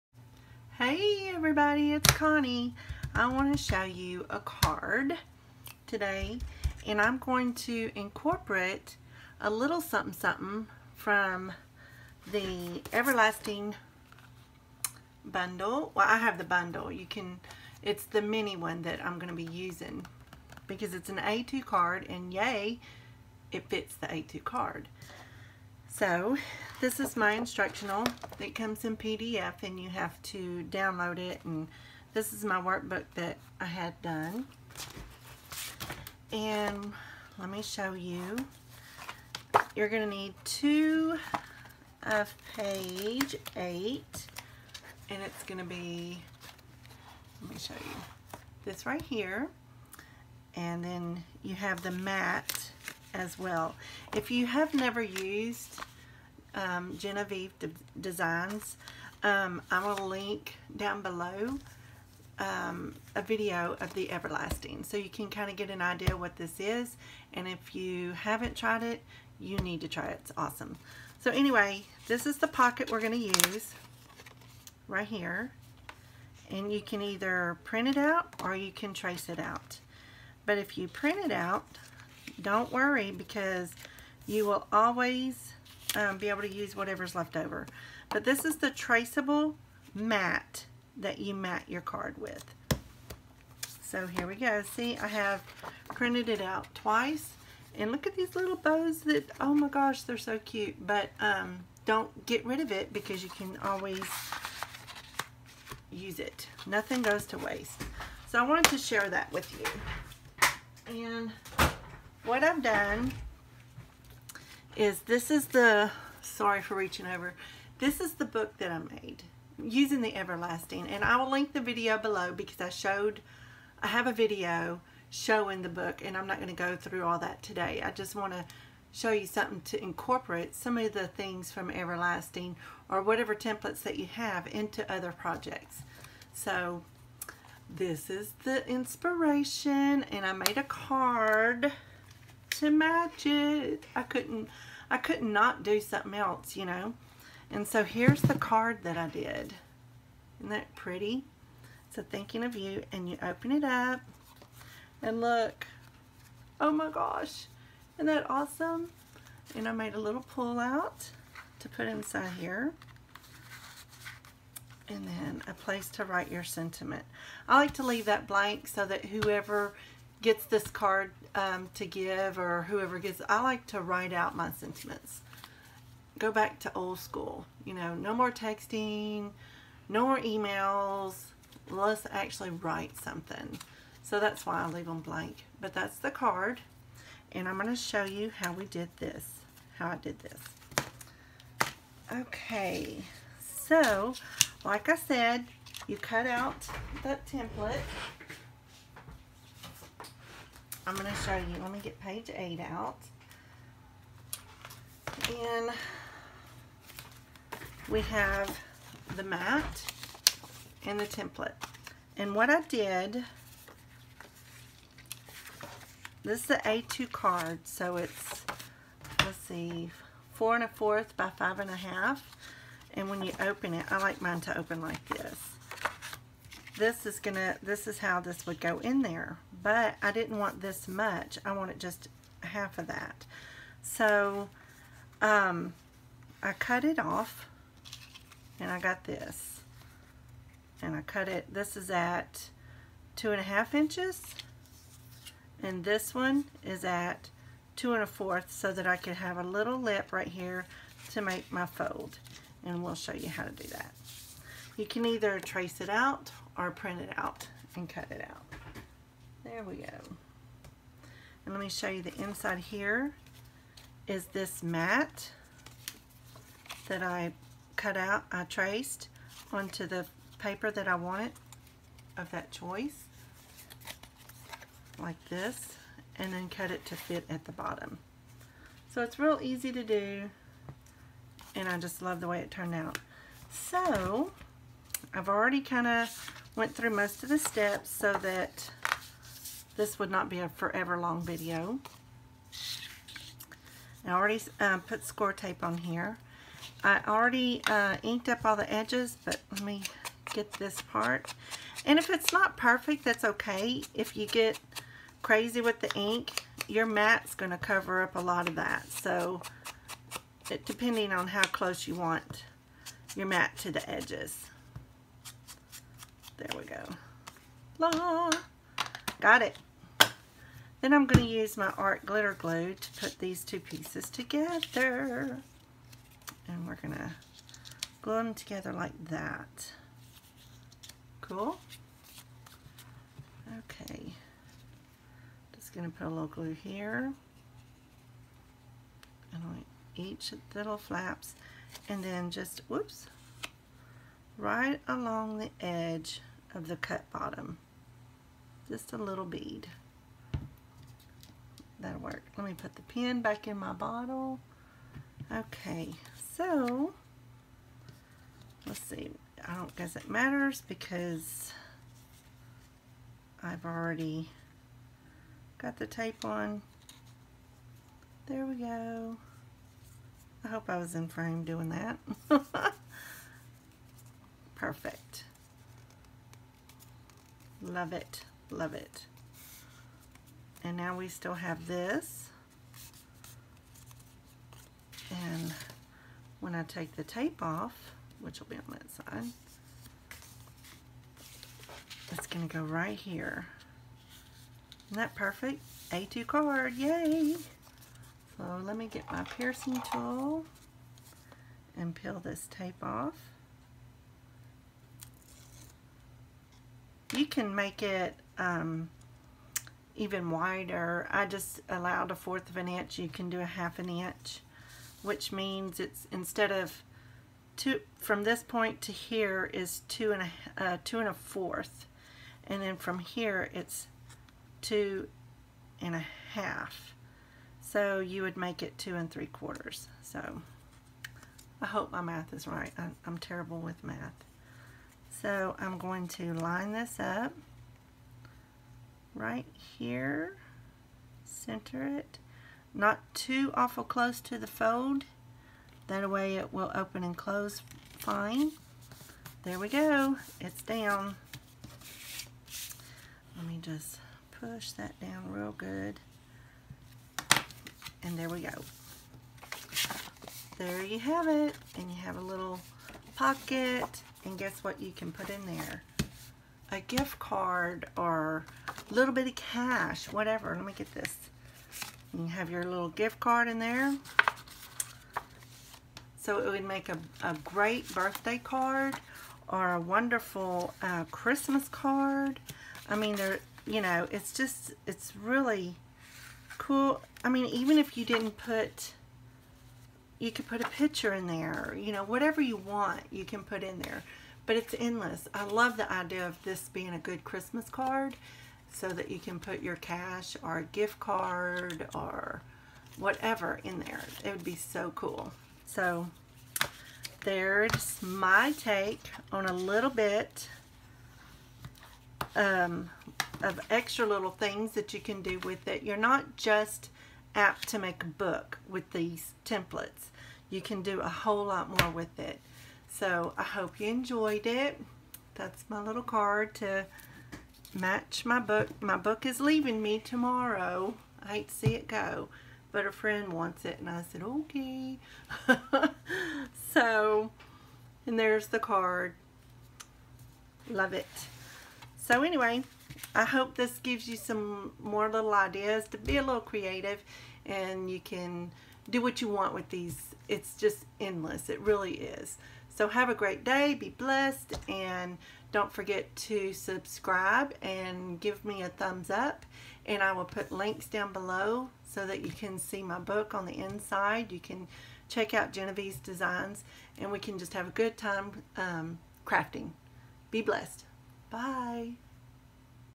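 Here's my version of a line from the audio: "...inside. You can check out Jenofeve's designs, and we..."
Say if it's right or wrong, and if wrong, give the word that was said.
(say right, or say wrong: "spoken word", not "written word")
right.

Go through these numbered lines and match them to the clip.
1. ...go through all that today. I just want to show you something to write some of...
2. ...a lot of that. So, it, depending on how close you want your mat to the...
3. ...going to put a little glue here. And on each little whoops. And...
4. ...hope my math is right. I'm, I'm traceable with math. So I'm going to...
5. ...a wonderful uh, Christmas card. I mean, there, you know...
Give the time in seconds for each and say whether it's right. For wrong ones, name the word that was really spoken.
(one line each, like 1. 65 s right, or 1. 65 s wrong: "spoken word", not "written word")
1. 126 s wrong: "incorporate", not "write"
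2. 308 s right
3. 335 s wrong: "flaps", not "whoops"
4. 431 s wrong: "terrible", not "traceable"
5. 479 s right.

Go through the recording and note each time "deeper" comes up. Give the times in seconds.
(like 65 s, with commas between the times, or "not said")
not said.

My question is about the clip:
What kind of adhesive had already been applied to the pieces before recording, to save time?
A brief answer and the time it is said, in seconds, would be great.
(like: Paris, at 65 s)
Score tape, at 295 s.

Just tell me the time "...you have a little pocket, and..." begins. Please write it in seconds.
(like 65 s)
461 s.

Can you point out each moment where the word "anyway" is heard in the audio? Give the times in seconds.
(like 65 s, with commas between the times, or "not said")
71 s, 542 s.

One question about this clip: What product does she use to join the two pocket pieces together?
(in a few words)
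Art glitter glue.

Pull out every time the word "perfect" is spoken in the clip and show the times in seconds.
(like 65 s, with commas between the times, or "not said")
302 s, 374 s, 395 s.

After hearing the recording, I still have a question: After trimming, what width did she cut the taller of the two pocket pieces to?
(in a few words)
2 1/2 inches.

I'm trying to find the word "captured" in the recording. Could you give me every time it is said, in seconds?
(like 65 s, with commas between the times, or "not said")
not said.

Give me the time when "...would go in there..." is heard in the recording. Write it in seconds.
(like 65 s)
228 s.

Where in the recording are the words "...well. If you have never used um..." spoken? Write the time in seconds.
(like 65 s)
53 s.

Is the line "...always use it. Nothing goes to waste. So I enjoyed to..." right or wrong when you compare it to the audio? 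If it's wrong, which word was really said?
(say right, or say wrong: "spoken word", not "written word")
wrong: "wanted", not "enjoyed".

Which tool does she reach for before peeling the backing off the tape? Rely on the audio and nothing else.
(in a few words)
Piercing tool.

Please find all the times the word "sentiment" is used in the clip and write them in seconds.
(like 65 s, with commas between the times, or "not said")
166 s, 174 s.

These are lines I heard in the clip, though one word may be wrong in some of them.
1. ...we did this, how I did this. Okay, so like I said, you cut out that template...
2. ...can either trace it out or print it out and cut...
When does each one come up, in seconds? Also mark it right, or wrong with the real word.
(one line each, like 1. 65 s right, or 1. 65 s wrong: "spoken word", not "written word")
1. 188 s right
2. 254 s right.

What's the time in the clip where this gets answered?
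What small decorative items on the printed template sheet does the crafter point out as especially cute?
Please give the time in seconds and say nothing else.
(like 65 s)
98 s.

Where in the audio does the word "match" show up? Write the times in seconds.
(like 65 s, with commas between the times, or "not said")
142 s, 527 s.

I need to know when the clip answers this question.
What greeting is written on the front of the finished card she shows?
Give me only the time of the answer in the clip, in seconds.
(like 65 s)
152 s.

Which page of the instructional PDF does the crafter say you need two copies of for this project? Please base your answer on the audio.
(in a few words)
Page 8.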